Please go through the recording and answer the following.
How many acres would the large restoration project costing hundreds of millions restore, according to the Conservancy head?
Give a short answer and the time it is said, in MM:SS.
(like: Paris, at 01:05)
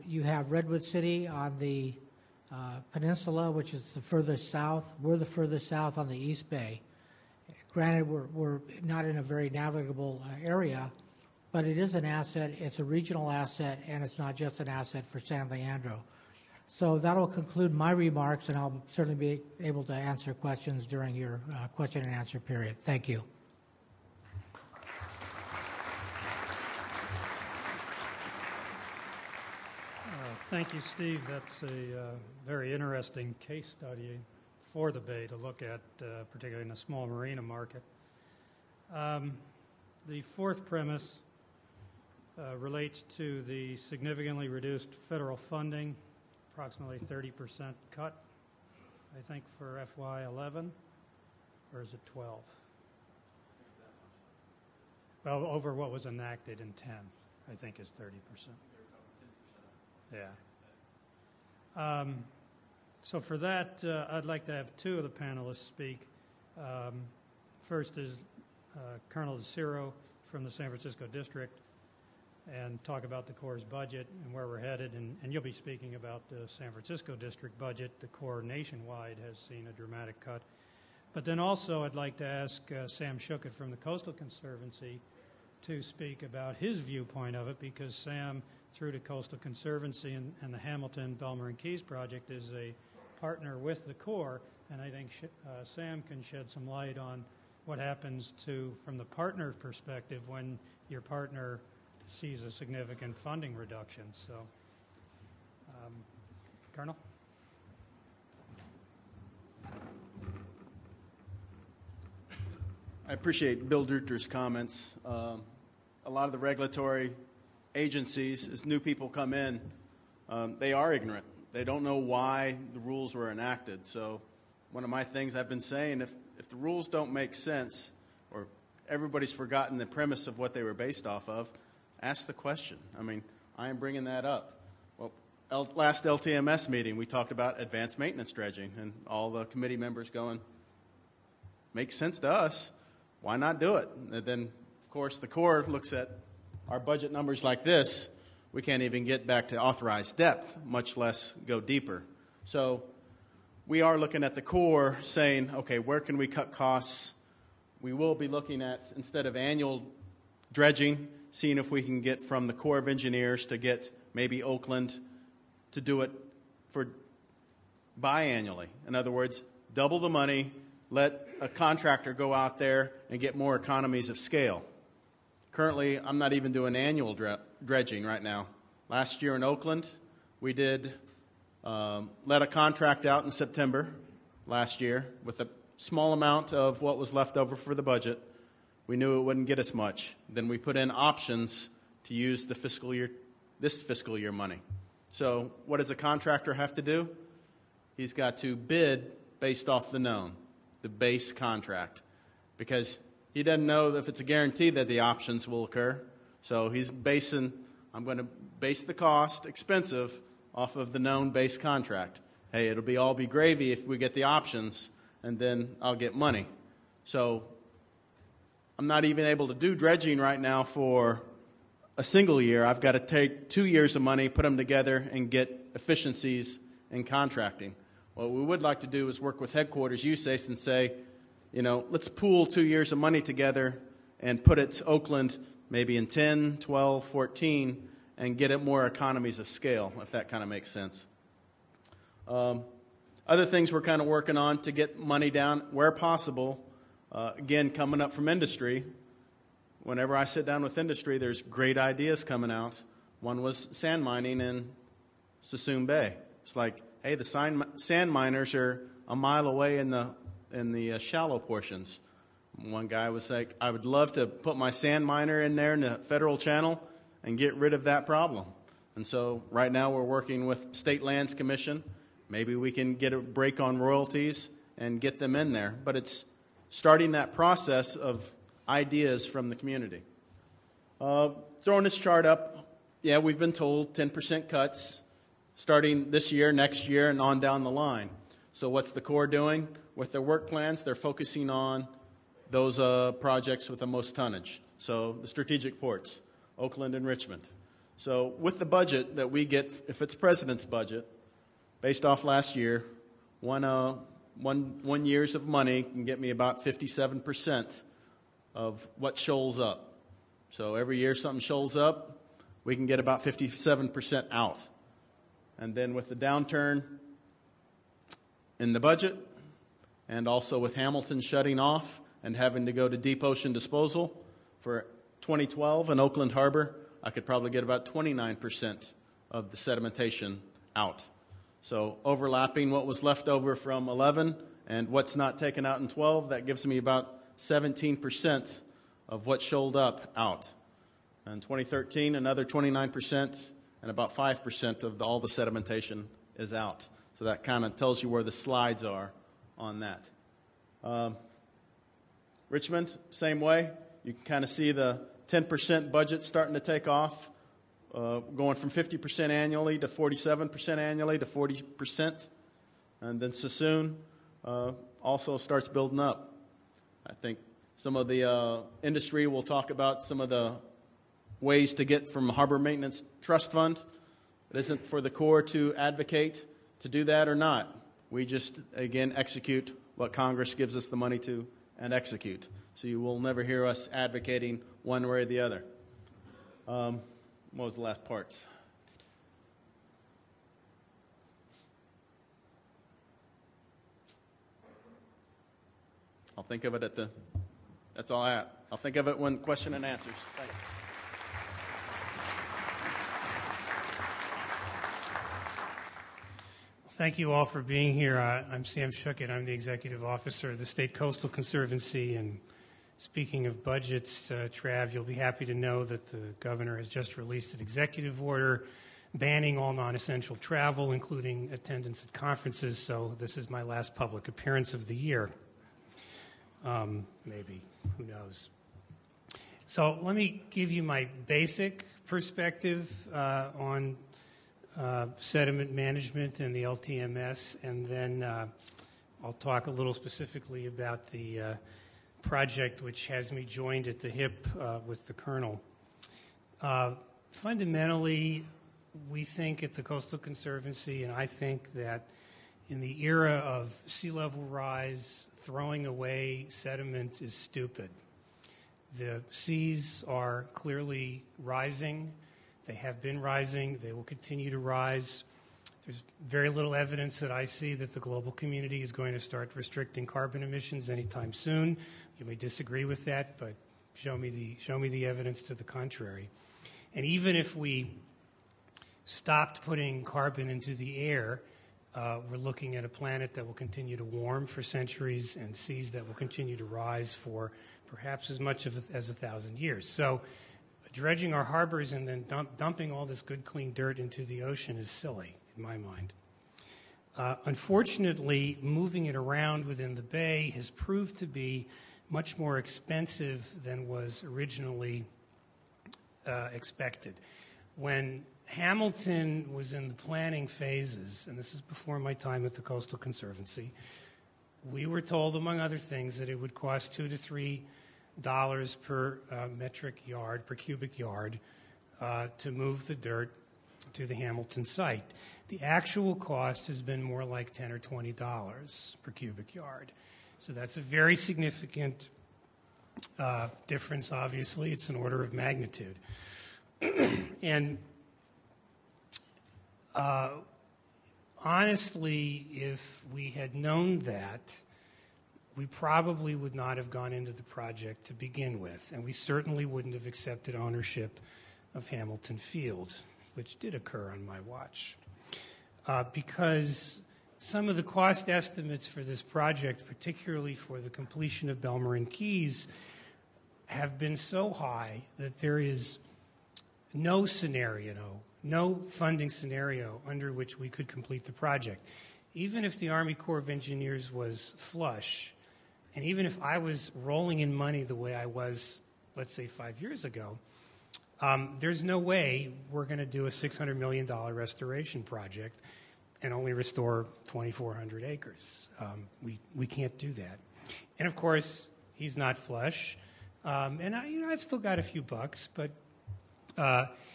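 2,400 acres, at 09:47.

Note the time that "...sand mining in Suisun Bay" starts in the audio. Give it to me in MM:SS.
04:13.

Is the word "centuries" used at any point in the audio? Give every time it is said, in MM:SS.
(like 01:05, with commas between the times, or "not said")
08:04.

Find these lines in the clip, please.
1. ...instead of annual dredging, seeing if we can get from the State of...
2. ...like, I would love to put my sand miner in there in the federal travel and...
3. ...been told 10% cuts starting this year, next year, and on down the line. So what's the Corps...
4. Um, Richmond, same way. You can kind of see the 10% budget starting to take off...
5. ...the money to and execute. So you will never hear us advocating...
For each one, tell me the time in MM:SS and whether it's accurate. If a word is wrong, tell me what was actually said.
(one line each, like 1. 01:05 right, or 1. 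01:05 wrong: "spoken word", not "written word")
1. 02:38 wrong: "Corps", not "State"
2. 04:23 wrong: "channel", not "travel"
3. 04:43 right
4. 05:50 right
5. 06:20 right.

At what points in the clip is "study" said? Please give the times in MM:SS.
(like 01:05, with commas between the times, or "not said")
00:33.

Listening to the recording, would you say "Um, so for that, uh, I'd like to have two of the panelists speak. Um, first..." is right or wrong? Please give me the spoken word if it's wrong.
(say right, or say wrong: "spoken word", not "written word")
right.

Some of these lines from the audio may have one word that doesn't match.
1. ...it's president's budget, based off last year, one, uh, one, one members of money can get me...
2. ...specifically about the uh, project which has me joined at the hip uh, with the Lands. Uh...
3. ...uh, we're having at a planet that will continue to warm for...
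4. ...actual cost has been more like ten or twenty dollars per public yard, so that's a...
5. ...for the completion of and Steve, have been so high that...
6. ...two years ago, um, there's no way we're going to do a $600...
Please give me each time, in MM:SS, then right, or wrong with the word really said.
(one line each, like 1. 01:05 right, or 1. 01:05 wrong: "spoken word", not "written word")
1. 05:00 wrong: "years", not "members"
2. 07:19 wrong: "Colonel", not "Lands"
3. 08:01 wrong: "looking", not "having"
4. 08:45 wrong: "cubic", not "public"
5. 09:20 wrong: "Keys", not "Steve"
6. 09:39 wrong: "five", not "two".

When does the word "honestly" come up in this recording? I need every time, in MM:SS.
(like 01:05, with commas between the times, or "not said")
09:01.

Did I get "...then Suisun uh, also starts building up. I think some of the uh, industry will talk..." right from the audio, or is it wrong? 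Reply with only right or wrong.
right.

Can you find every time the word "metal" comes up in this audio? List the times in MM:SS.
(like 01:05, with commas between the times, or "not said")
not said.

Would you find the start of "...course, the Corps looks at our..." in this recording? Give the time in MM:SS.
02:24.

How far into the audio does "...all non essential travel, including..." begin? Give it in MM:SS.
06:59.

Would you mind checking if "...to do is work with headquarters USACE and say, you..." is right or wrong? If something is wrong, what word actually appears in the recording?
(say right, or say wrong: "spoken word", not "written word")
right.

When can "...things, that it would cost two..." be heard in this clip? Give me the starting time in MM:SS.
08:35.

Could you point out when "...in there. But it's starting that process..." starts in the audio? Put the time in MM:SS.
04:35.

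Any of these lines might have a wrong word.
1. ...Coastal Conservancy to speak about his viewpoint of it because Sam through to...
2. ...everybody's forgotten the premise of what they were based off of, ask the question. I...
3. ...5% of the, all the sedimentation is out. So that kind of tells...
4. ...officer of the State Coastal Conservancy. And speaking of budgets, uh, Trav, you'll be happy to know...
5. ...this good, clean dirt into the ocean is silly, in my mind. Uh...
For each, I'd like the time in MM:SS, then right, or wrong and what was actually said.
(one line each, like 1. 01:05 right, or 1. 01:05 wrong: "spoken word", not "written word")
1. 01:23 right
2. 02:08 right
3. 05:44 right
4. 06:50 right
5. 08:13 right.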